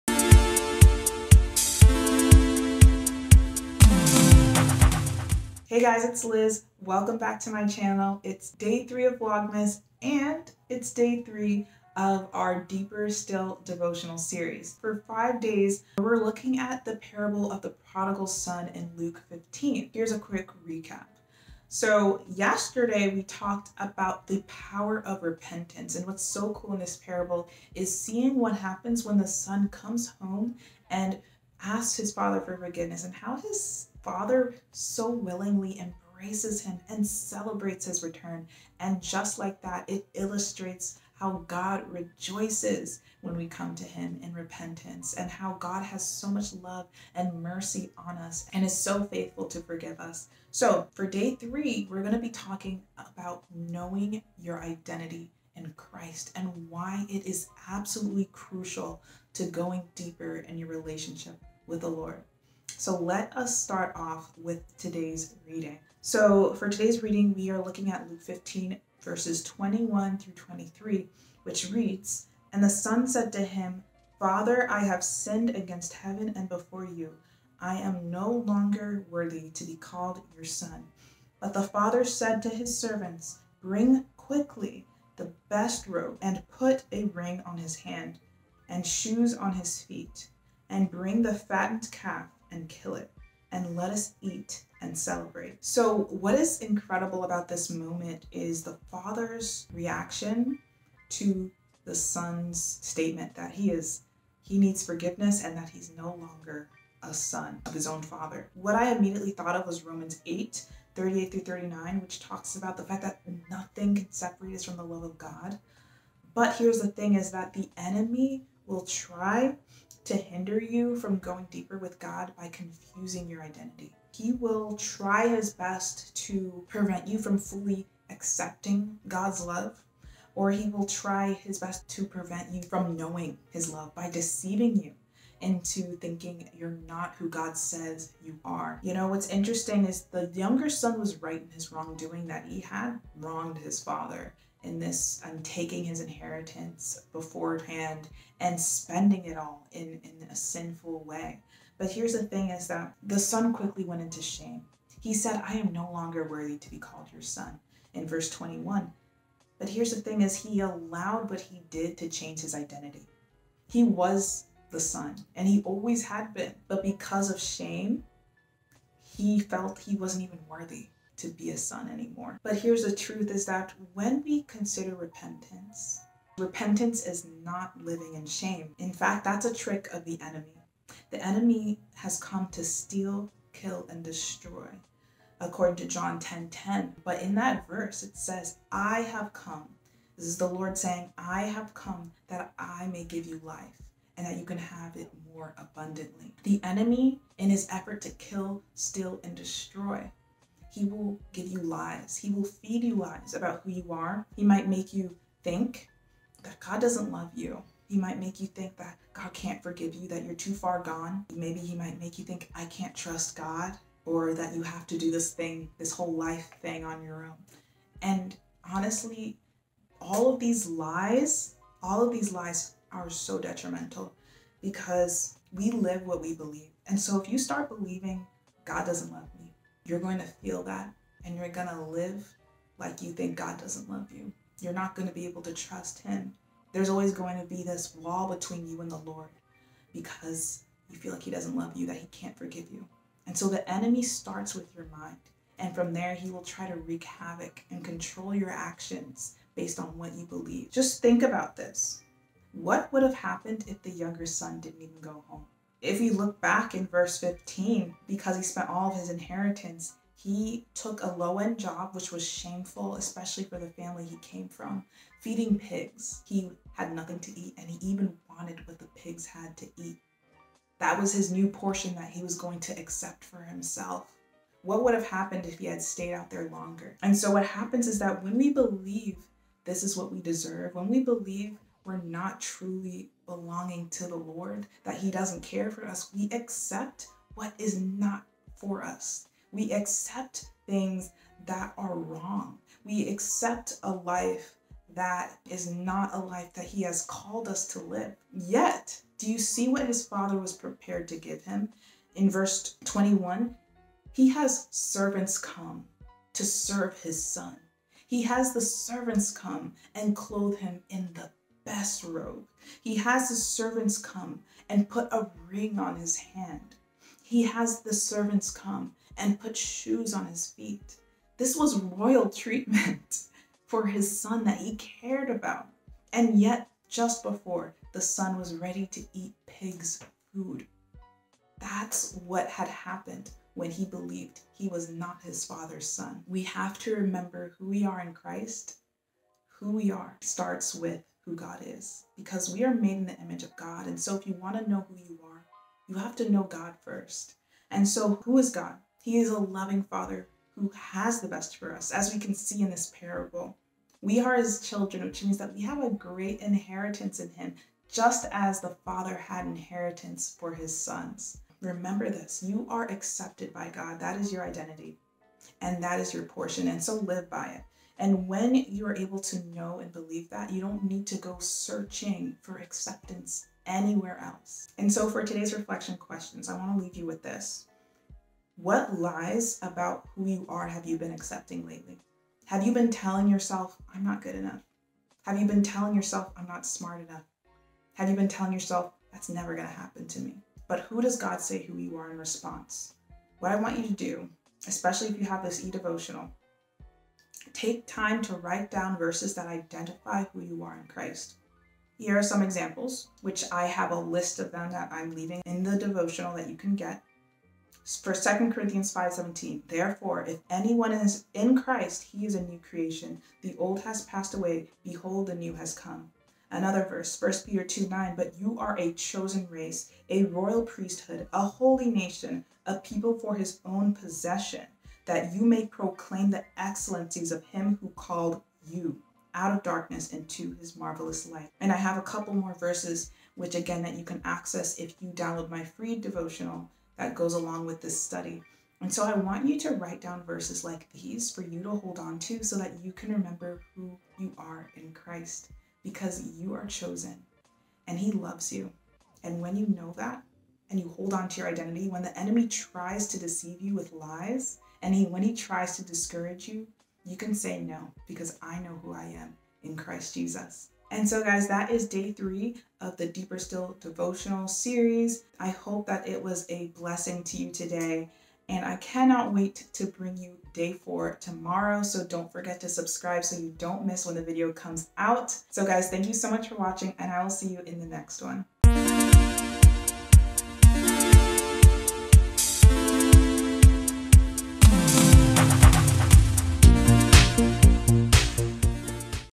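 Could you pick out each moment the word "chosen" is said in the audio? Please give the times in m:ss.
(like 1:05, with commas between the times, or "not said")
6:58, 7:26.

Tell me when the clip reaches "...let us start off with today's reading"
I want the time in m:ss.
1:02.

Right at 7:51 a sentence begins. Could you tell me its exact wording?
So don't forget to subscribe so you don't miss when the video comes out.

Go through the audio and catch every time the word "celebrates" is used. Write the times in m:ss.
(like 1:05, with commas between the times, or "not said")
0:37, 1:34.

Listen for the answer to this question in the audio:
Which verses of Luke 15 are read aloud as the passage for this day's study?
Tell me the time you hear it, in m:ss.
1:09.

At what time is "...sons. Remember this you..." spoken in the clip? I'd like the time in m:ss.
6:00.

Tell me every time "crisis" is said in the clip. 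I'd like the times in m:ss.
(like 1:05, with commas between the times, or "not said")
not said.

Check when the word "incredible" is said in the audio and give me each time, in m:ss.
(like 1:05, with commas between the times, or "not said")
1:36.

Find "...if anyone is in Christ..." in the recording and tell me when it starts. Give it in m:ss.
6:50.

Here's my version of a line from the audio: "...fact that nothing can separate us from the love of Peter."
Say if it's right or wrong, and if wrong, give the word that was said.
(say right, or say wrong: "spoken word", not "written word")
wrong: "God", not "Peter".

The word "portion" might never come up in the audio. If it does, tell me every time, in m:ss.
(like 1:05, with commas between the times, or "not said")
4:31, 6:06.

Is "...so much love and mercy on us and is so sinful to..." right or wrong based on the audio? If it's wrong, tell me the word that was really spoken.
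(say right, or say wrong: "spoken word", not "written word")
wrong: "faithful", not "sinful".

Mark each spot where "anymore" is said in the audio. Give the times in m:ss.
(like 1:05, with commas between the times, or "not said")
2:51.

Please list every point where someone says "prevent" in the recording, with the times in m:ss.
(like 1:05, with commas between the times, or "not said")
2:06, 2:12.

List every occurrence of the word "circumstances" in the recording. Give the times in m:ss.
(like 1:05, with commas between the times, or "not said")
not said.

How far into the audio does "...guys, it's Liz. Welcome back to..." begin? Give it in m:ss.
0:05.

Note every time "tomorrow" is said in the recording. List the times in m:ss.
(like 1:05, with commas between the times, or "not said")
7:51.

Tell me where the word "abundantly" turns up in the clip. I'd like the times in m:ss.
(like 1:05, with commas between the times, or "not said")
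3:15.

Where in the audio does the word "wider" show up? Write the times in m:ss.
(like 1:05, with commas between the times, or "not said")
not said.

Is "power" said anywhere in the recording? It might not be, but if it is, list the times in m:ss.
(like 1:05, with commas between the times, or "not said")
0:24.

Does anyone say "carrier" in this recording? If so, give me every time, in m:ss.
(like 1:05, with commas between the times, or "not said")
not said.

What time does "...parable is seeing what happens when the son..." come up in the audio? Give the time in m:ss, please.
0:26.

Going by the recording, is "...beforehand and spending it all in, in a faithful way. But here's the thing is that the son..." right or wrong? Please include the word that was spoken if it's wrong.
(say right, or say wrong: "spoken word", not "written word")
wrong: "sinful", not "faithful".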